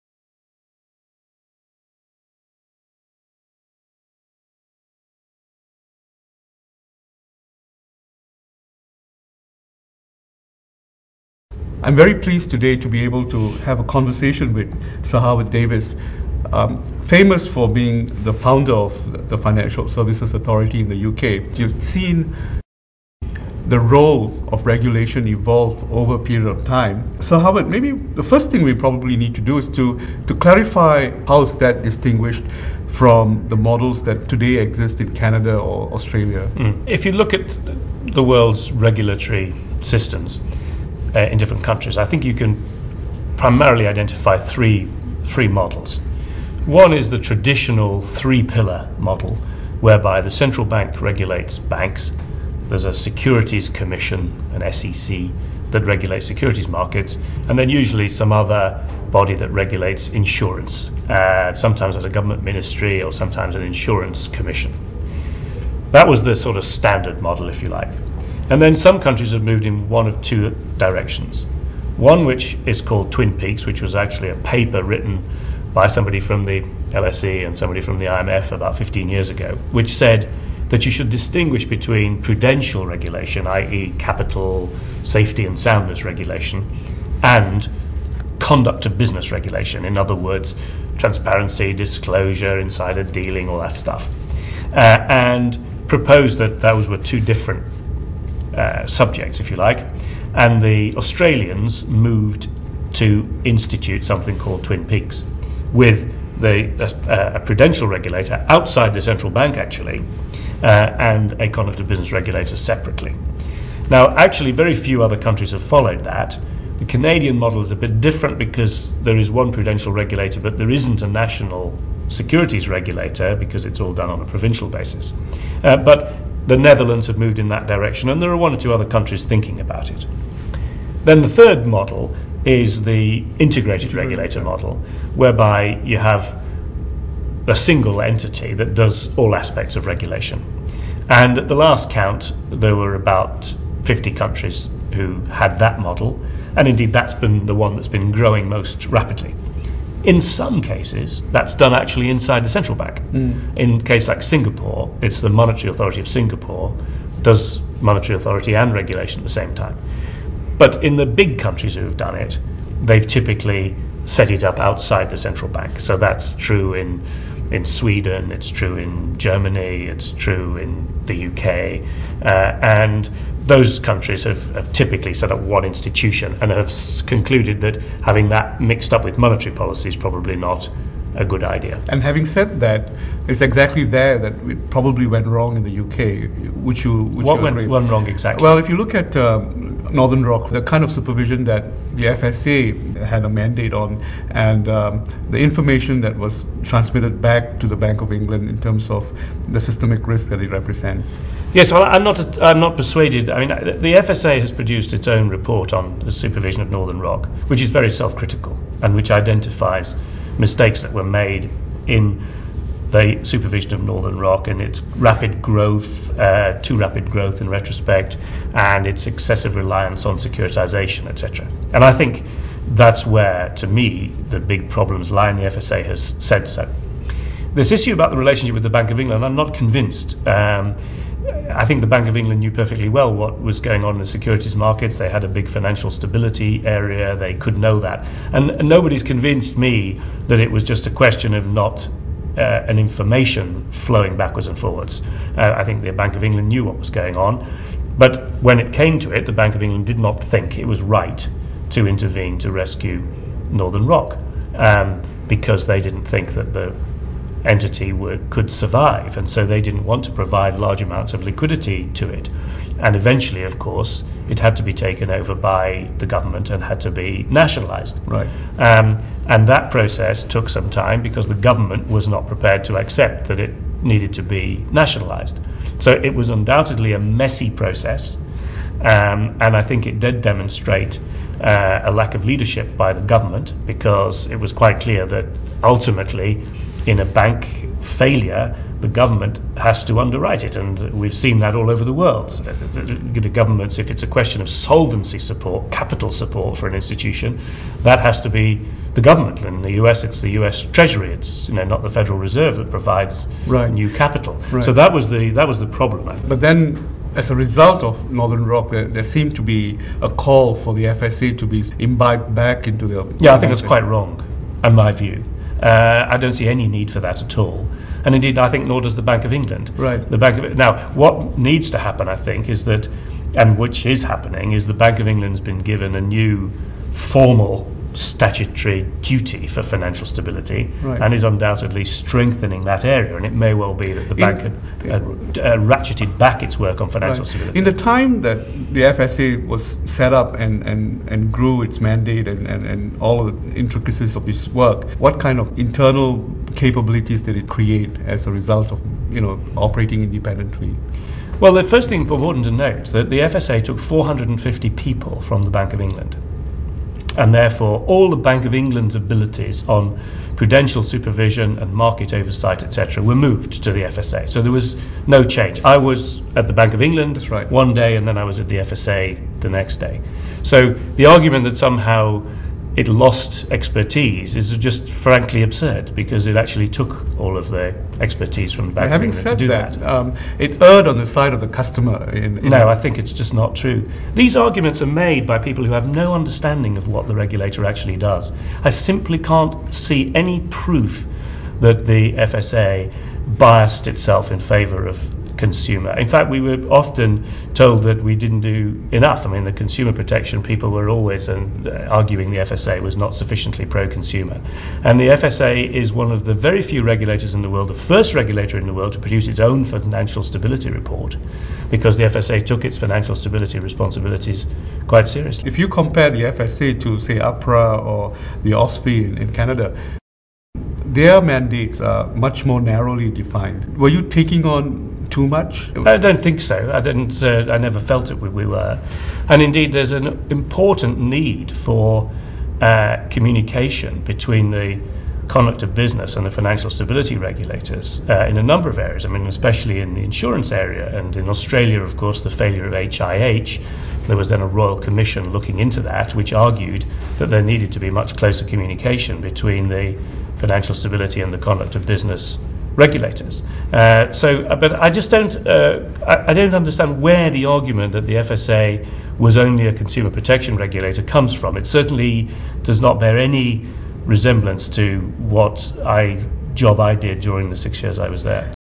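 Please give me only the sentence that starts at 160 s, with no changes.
But in the big countries who've done it, they've typically set it up outside the central bank.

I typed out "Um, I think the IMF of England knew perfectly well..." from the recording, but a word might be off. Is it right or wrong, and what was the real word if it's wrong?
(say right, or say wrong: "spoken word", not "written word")
wrong: "Bank", not "IMF".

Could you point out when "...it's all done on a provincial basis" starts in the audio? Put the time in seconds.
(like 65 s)
123 s.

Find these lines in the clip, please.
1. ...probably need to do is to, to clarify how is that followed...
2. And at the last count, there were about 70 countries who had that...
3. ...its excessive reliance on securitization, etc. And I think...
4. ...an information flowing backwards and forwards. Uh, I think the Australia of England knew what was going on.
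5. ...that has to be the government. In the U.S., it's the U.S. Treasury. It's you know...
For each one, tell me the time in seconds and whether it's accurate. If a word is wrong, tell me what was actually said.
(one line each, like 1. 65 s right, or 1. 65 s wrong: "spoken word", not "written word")
1. 28 s wrong: "distinguished", not "followed"
2. 141 s wrong: "50", not "70"
3. 218 s right
4. 242 s wrong: "Bank", not "Australia"
5. 297 s right.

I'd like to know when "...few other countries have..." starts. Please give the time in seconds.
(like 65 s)
114 s.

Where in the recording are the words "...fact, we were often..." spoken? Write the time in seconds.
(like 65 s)
396 s.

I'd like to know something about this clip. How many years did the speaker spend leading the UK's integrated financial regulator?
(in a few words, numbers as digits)
6.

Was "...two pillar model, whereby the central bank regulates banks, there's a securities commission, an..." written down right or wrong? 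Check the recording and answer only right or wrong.
wrong.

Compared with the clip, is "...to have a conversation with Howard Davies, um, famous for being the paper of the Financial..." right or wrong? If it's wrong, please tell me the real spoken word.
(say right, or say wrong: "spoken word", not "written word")
wrong: "founder", not "paper".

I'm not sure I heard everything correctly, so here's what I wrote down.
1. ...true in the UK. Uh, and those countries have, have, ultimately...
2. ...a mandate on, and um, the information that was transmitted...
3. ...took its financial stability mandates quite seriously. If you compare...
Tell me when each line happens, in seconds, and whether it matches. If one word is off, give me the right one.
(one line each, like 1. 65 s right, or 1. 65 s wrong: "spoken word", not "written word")
1. 170 s wrong: "typically", not "ultimately"
2. 193 s right
3. 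412 s wrong: "responsibilities", not "mandates".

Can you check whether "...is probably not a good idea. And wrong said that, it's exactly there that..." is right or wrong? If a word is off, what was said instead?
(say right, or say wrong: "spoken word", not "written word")
wrong: "having", not "wrong".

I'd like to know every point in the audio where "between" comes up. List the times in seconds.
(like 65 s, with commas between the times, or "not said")
81 s, 434 s, 449 s.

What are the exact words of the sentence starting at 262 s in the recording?
And eventually, of course, it had to be taken over by the government and had to be nationalized.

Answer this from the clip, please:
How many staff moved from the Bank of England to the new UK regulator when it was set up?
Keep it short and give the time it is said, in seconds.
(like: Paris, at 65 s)
450, at 353 s.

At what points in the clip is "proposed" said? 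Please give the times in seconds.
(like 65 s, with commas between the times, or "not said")
95 s.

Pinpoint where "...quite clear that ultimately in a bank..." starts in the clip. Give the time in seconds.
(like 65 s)
284 s.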